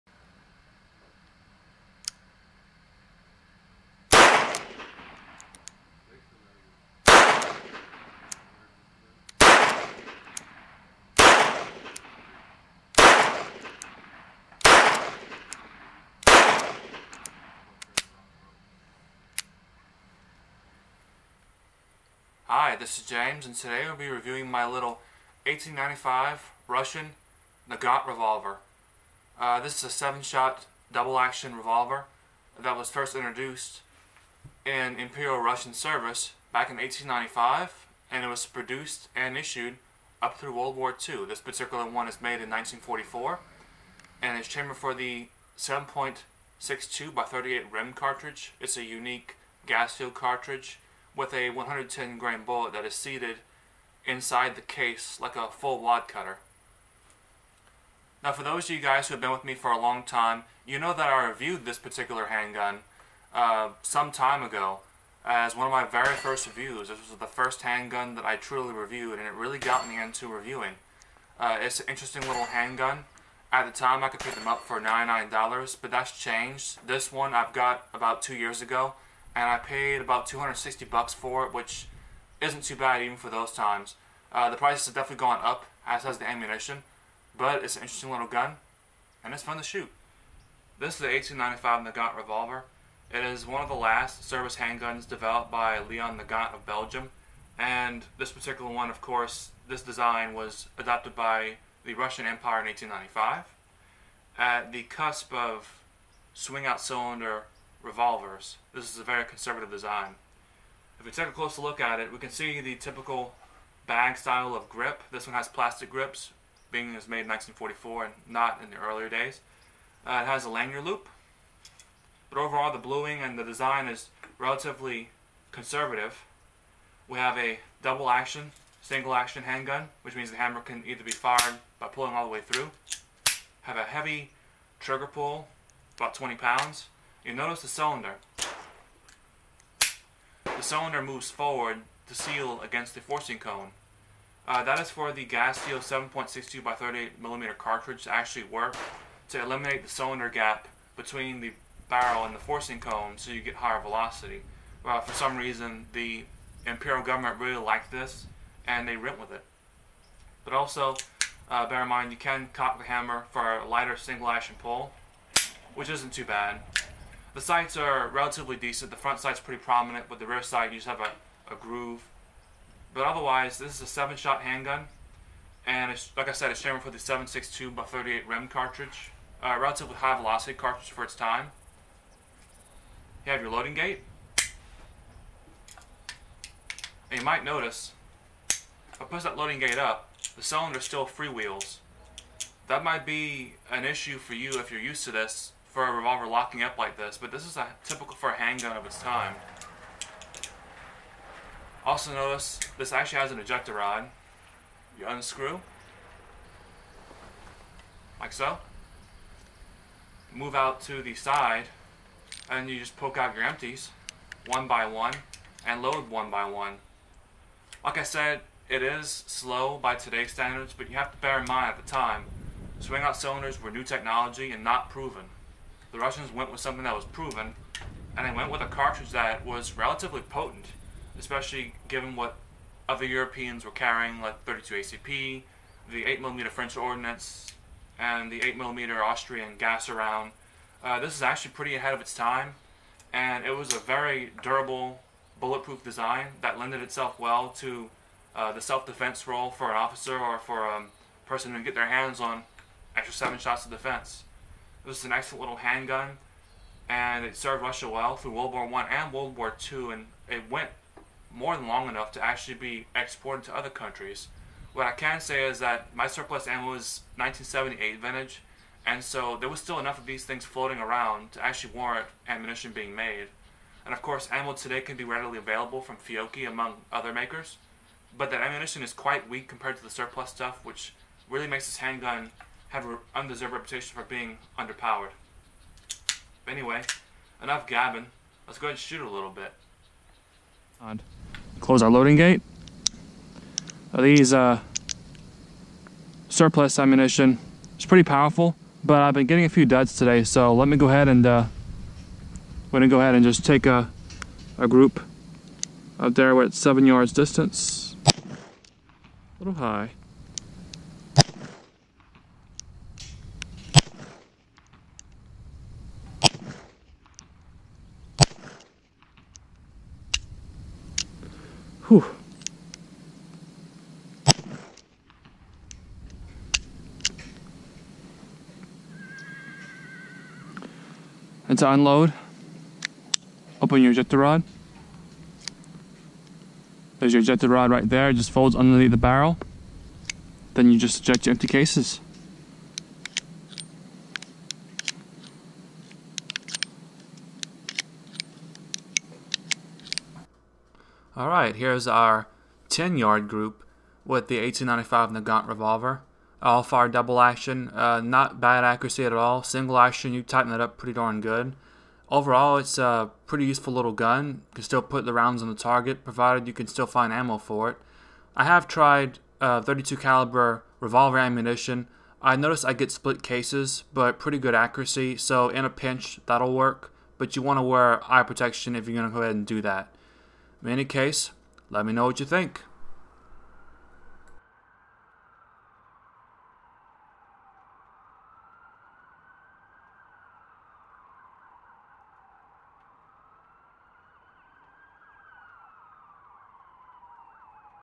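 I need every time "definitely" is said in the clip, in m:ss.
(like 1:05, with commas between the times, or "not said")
1:24.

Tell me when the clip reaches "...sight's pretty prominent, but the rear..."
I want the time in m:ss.
2:49.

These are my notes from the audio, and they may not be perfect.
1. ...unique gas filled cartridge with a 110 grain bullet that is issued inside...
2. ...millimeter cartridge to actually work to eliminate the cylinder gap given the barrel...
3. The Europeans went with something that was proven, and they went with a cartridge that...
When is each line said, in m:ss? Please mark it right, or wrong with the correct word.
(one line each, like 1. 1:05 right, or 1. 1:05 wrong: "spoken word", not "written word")
1. 0:48 wrong: "seated", not "issued"
2. 2:27 wrong: "between", not "given"
3. 3:45 wrong: "Russians", not "Europeans".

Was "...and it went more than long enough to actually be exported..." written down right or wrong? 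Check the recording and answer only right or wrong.
right.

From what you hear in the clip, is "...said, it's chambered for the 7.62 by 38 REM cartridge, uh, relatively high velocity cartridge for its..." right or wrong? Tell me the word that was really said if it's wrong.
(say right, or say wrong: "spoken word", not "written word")
right.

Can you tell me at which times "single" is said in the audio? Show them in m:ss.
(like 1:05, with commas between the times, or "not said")
2:08, 2:43, 5:59.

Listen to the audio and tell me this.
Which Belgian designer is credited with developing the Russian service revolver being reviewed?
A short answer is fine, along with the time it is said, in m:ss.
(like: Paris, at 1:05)
Leon Nagant, at 1:35.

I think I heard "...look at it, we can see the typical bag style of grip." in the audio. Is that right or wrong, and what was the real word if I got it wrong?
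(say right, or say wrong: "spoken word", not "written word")
right.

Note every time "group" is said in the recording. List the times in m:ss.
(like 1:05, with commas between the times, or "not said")
5:04, 5:53.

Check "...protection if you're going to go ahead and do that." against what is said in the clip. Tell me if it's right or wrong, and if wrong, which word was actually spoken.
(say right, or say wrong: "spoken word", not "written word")
right.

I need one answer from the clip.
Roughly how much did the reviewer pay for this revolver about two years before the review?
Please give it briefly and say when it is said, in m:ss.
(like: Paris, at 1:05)
$260, at 1:20.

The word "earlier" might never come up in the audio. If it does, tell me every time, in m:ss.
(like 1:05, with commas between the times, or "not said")
1:58.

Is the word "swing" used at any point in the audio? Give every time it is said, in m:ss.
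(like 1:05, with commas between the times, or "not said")
1:46, 3:42.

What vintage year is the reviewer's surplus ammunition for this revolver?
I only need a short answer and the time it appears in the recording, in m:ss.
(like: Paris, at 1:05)
1978, at 4:27.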